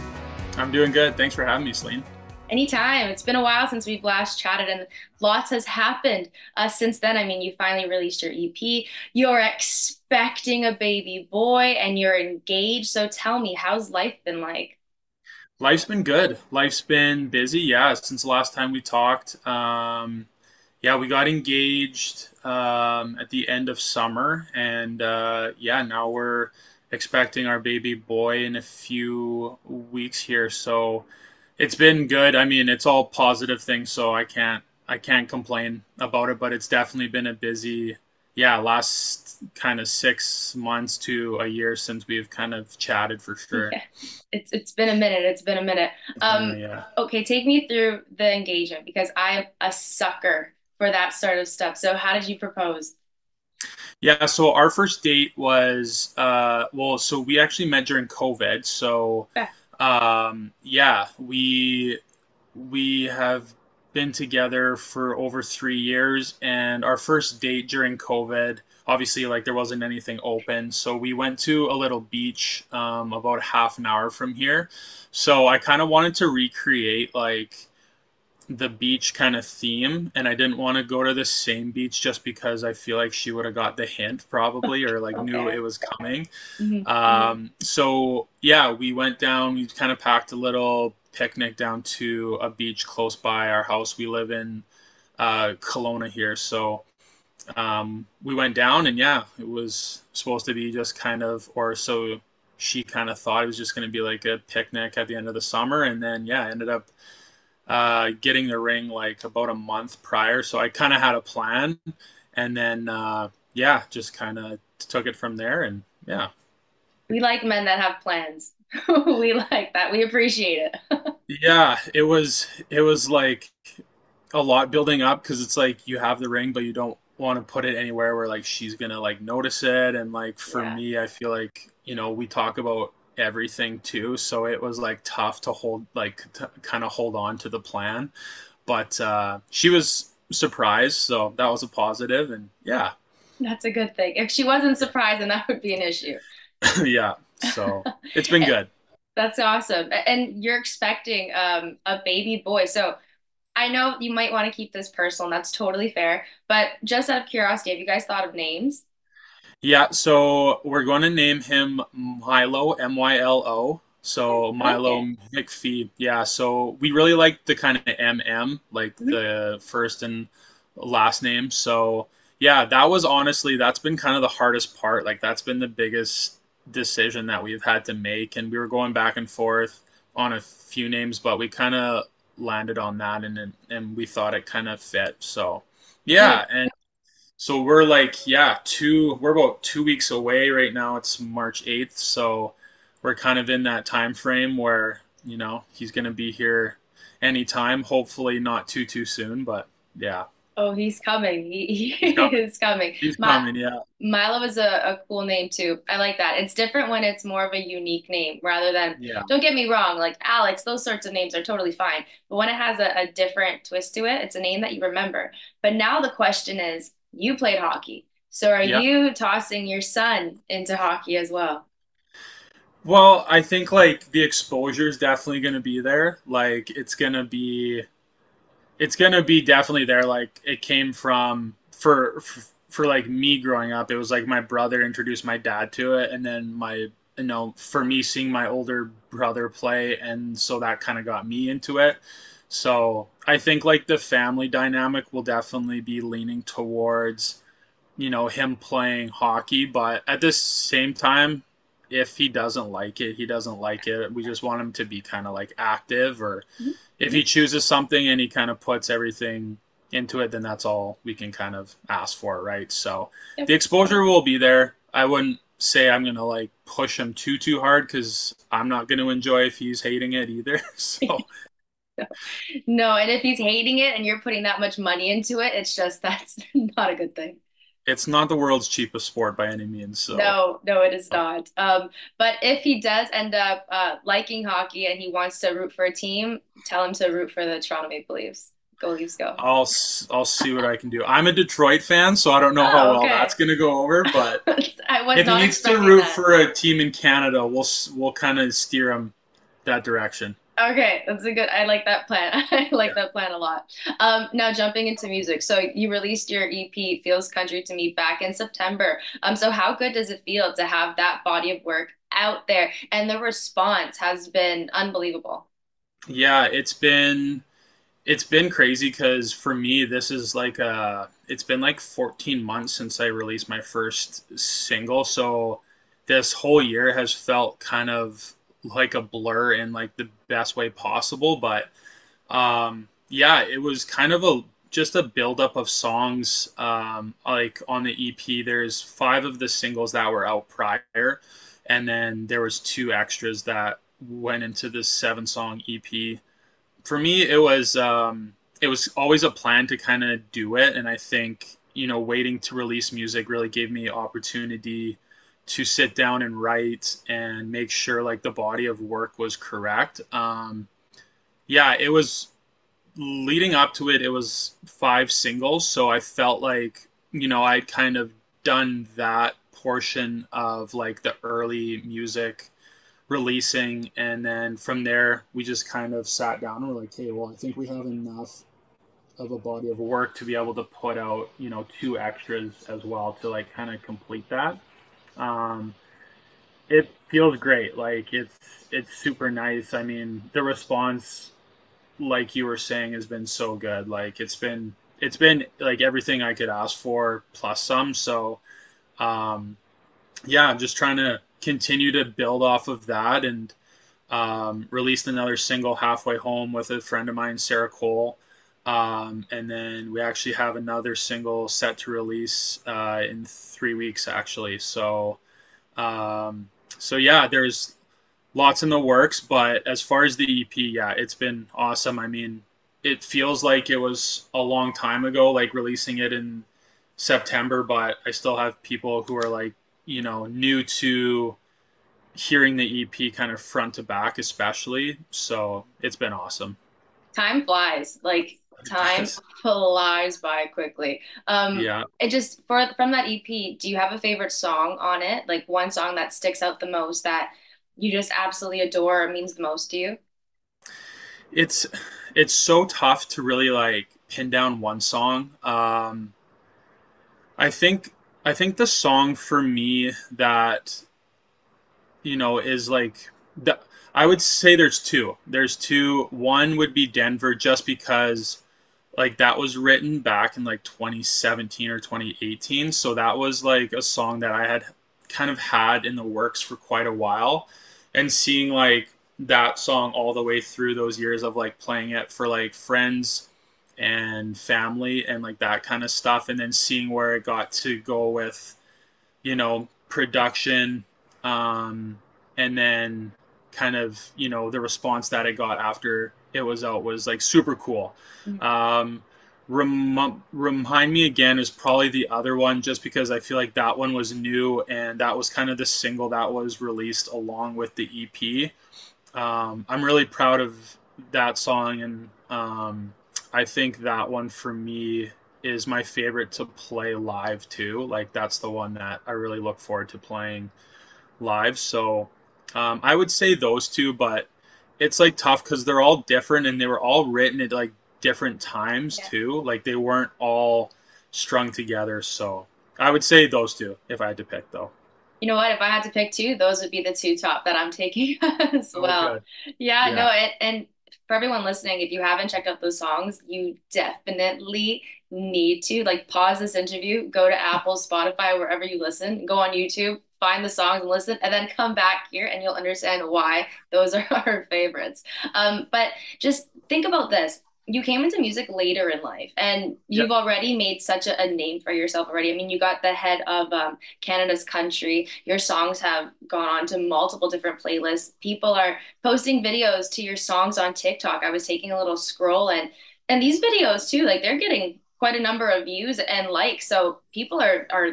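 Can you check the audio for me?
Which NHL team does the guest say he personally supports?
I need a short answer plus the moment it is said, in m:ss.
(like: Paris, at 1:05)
Detroit, at 4:51.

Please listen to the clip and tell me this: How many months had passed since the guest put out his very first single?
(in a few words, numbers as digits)
14.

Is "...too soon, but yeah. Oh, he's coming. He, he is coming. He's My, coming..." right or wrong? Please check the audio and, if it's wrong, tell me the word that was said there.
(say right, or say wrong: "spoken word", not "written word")
right.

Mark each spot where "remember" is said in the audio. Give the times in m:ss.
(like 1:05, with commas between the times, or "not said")
3:34.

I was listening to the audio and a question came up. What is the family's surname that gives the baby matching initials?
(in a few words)
McPhee.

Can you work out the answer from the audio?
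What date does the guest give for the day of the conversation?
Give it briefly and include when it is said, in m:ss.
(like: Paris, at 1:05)
March 8, at 3:11.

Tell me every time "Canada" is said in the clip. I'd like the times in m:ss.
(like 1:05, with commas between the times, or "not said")
4:56, 9:23.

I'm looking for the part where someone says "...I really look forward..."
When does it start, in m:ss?
8:39.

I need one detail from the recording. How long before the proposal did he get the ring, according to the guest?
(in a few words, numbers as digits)
about a month.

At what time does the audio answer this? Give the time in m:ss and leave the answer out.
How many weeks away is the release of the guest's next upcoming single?
6:53.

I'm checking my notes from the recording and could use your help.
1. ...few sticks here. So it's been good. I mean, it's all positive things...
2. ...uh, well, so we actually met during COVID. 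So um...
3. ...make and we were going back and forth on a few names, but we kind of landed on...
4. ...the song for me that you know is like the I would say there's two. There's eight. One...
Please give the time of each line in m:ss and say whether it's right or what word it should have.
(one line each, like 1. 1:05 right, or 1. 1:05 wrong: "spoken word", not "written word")
1. 0:28 wrong: "weeks", not "sticks"
2. 0:56 right
3. 2:57 right
4. 7:38 wrong: "two", not "eight".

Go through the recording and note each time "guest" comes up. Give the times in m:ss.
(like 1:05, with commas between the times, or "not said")
not said.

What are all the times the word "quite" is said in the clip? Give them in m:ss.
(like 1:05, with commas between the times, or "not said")
7:56, 9:34.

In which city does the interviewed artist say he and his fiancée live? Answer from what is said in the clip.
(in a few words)
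Kelowna.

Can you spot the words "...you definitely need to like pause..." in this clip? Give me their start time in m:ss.
9:03.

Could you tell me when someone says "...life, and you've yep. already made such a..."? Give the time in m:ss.
9:19.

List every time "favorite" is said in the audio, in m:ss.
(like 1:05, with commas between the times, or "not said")
7:23, 8:35, 9:14.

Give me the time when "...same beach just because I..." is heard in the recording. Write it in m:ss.
1:21.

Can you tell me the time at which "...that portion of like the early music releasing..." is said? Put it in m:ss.
6:08.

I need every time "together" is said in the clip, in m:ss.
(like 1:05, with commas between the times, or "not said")
1:04, 8:51.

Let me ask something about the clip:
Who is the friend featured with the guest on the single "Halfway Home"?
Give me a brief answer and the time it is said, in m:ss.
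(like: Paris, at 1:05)
Sarah Cole, at 6:47.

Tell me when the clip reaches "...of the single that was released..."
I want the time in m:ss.
8:25.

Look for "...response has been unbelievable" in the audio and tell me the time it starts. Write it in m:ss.
5:13.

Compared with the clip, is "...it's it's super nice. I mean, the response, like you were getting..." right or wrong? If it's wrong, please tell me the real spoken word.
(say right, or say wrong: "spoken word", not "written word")
wrong: "saying", not "getting".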